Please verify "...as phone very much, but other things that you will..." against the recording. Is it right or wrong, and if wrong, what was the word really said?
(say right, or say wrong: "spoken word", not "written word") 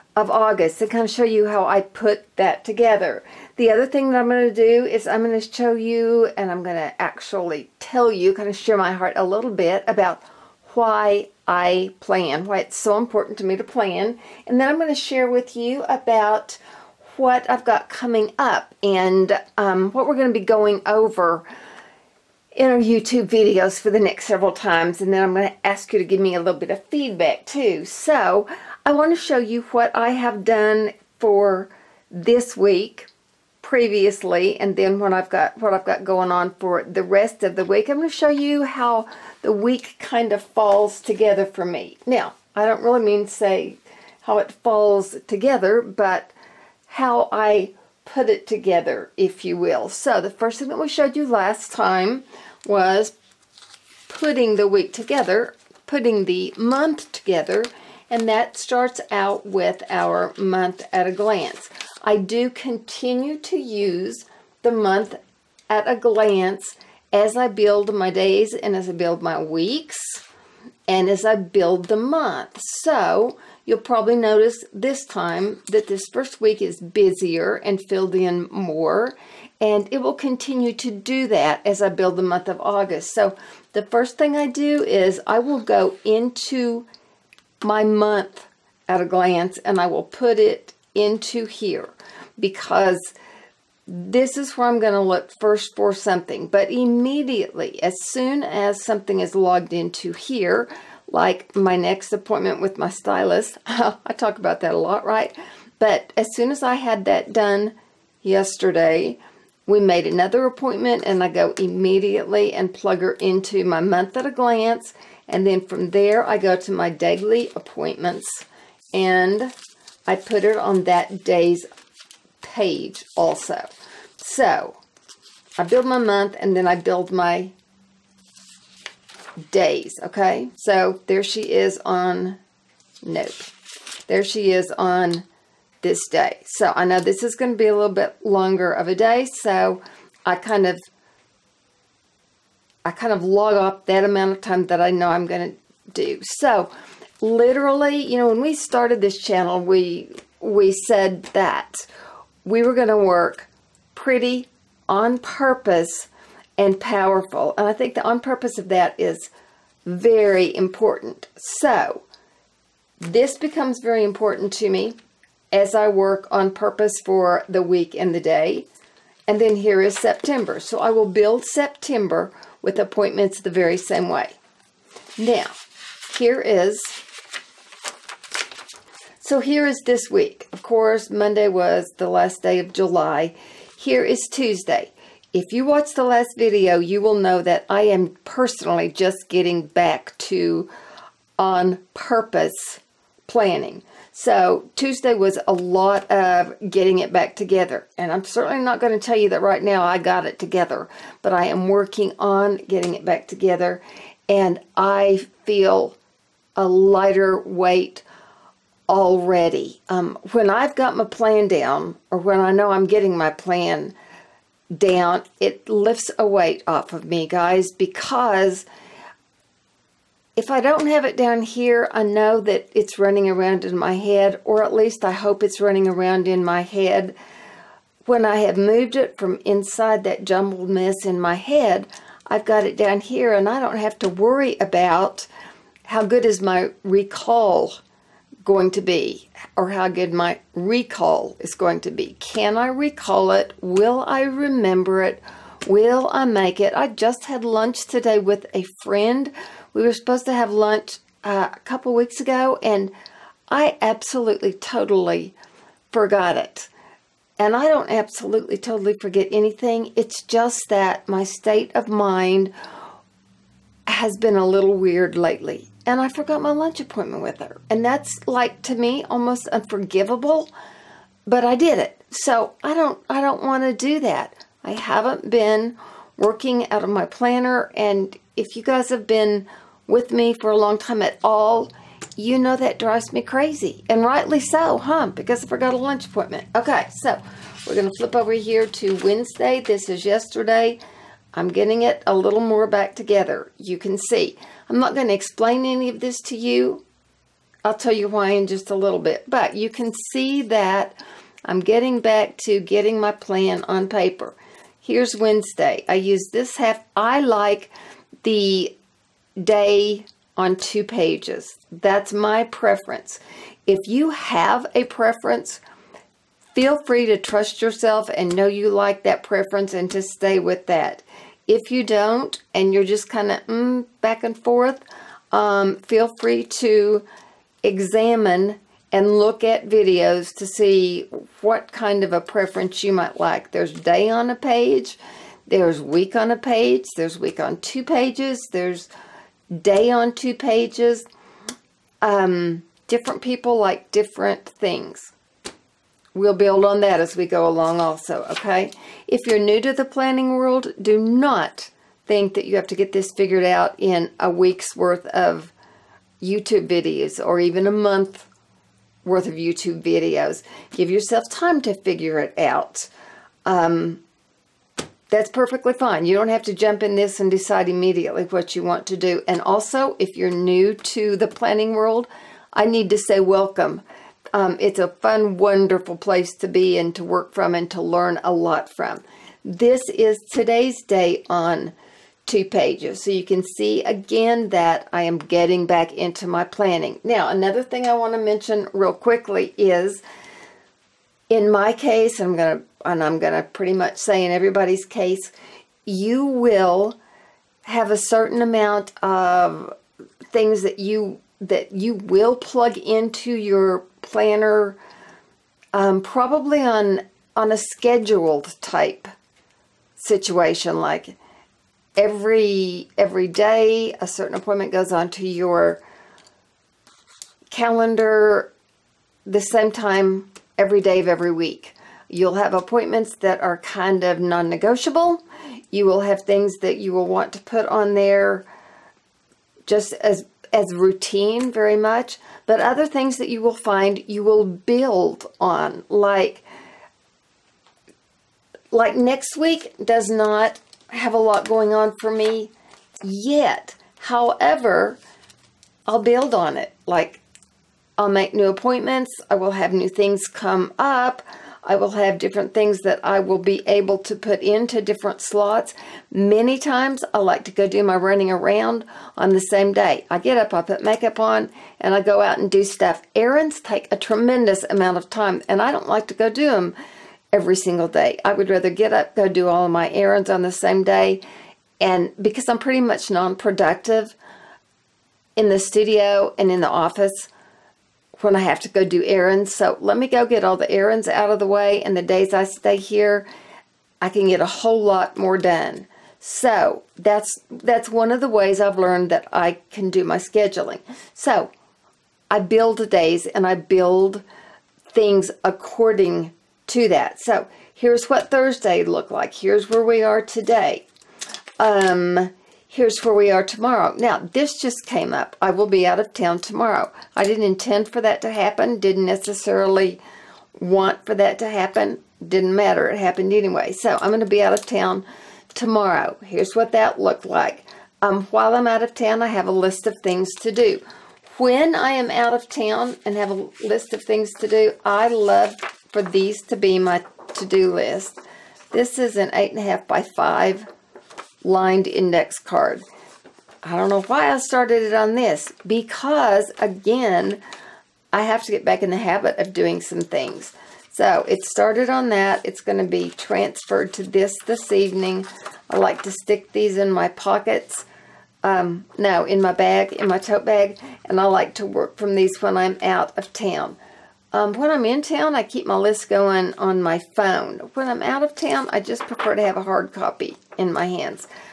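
wrong: "routine", not "phone".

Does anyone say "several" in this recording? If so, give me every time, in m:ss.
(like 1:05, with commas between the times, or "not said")
0:24.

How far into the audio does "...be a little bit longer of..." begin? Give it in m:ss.
2:17.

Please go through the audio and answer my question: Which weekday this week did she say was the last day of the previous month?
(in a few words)
Monday.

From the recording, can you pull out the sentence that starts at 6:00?
Give yourself time to figure it out.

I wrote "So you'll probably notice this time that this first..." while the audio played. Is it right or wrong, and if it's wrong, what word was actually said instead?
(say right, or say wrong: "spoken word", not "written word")
right.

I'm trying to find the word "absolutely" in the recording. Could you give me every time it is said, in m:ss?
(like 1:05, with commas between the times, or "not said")
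4:13, 4:17.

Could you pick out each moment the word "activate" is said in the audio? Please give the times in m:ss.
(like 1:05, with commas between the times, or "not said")
not said.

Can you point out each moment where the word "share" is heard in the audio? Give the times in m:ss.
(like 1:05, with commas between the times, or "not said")
0:08, 0:14.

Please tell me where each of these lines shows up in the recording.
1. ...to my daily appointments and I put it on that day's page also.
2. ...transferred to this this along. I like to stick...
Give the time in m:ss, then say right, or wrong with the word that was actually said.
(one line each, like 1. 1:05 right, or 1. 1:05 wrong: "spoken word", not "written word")
1. 1:56 right
2. 9:03 wrong: "evening", not "along".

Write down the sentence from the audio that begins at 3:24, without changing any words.
And I feel a lighter weight already.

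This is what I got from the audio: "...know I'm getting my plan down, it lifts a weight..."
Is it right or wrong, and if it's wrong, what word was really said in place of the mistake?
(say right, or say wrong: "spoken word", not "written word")
right.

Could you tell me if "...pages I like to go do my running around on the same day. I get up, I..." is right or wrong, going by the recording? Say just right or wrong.
wrong.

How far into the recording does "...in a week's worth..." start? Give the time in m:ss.
5:53.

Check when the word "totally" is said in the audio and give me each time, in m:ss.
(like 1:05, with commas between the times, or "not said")
4:14, 4:18.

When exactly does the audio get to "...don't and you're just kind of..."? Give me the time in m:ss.
5:21.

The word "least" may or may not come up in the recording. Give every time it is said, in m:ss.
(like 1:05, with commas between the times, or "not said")
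3:44.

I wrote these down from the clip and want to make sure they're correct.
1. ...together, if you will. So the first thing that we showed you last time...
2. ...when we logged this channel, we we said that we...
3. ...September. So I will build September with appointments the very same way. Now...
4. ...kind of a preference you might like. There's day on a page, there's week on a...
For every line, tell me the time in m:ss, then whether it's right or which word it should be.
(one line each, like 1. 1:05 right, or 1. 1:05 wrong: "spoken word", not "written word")
1. 0:48 right
2. 2:28 wrong: "started", not "logged"
3. 2:49 right
4. 5:31 right.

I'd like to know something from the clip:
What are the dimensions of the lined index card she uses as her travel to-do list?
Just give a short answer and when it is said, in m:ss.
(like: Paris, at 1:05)
8.5 by 5, at 8:49.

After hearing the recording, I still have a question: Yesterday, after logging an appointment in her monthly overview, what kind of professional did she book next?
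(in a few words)
Stylist.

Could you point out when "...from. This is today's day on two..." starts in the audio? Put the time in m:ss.
6:18.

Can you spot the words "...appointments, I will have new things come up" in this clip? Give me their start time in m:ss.
7:28.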